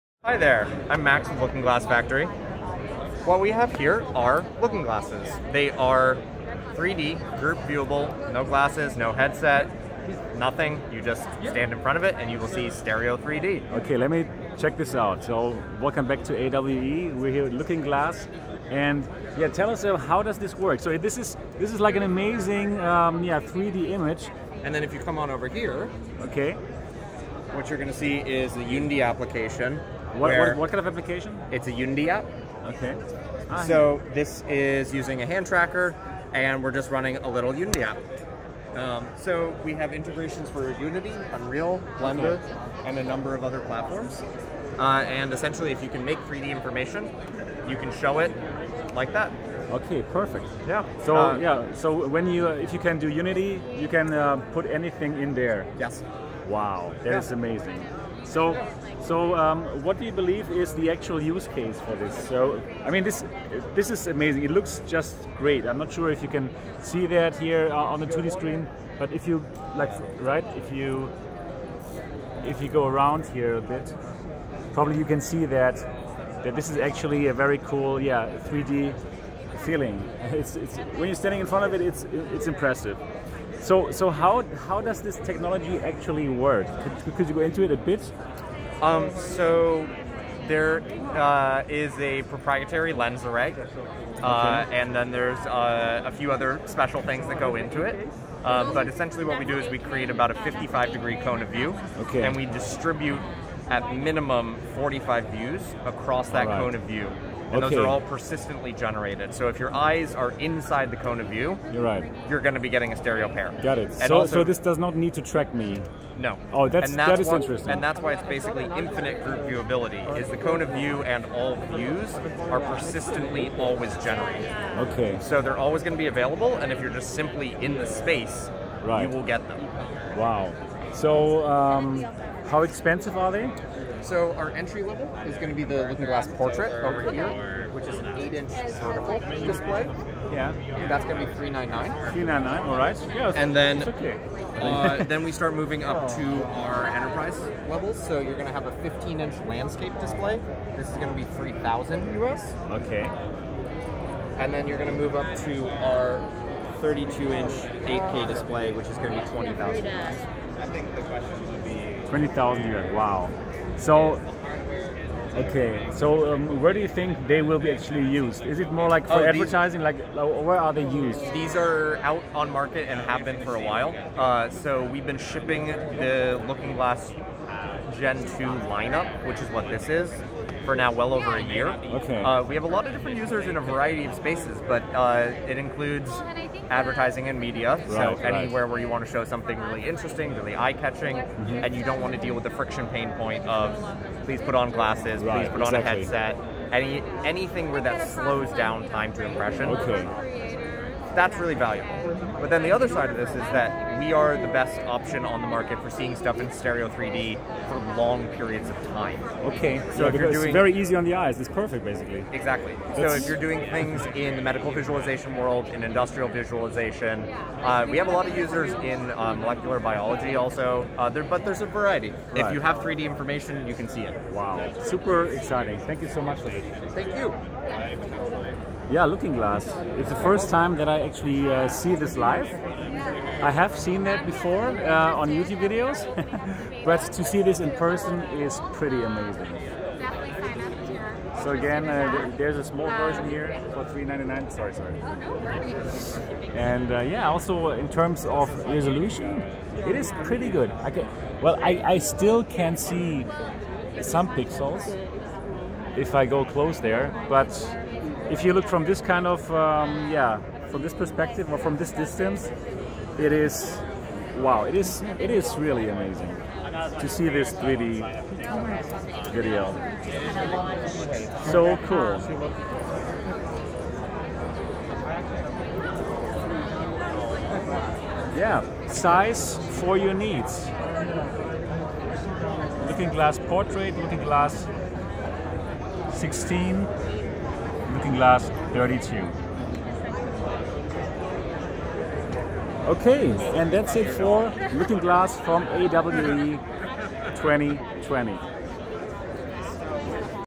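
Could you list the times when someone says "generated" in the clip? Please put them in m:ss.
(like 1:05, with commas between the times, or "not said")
1:48, 2:03.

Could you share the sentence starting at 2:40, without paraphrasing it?
I think the question would be 20,000 yuan.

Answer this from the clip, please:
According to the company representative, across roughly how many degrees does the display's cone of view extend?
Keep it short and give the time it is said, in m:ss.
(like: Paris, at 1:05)
55 degrees, at 1:40.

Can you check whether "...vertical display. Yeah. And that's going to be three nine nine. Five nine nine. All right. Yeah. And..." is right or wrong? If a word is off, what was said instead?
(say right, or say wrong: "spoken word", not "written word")
wrong: "Three", not "Five".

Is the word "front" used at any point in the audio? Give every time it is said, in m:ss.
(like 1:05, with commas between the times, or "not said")
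0:11, 1:21.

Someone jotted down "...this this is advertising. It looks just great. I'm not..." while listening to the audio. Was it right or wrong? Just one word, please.
wrong.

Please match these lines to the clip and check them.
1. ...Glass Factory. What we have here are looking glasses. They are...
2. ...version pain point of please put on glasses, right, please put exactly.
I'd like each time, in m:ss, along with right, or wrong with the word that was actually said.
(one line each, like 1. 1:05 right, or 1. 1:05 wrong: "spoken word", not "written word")
1. 0:01 right
2. 3:12 wrong: "friction", not "version".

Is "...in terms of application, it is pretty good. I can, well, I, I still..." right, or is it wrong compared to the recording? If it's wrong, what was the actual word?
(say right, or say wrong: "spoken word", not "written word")
wrong: "resolution", not "application".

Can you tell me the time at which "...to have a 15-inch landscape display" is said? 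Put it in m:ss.
2:28.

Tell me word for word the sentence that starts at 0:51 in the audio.
So when you, if you can do Unity, you can uh, put anything in there.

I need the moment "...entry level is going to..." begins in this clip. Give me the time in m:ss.
2:14.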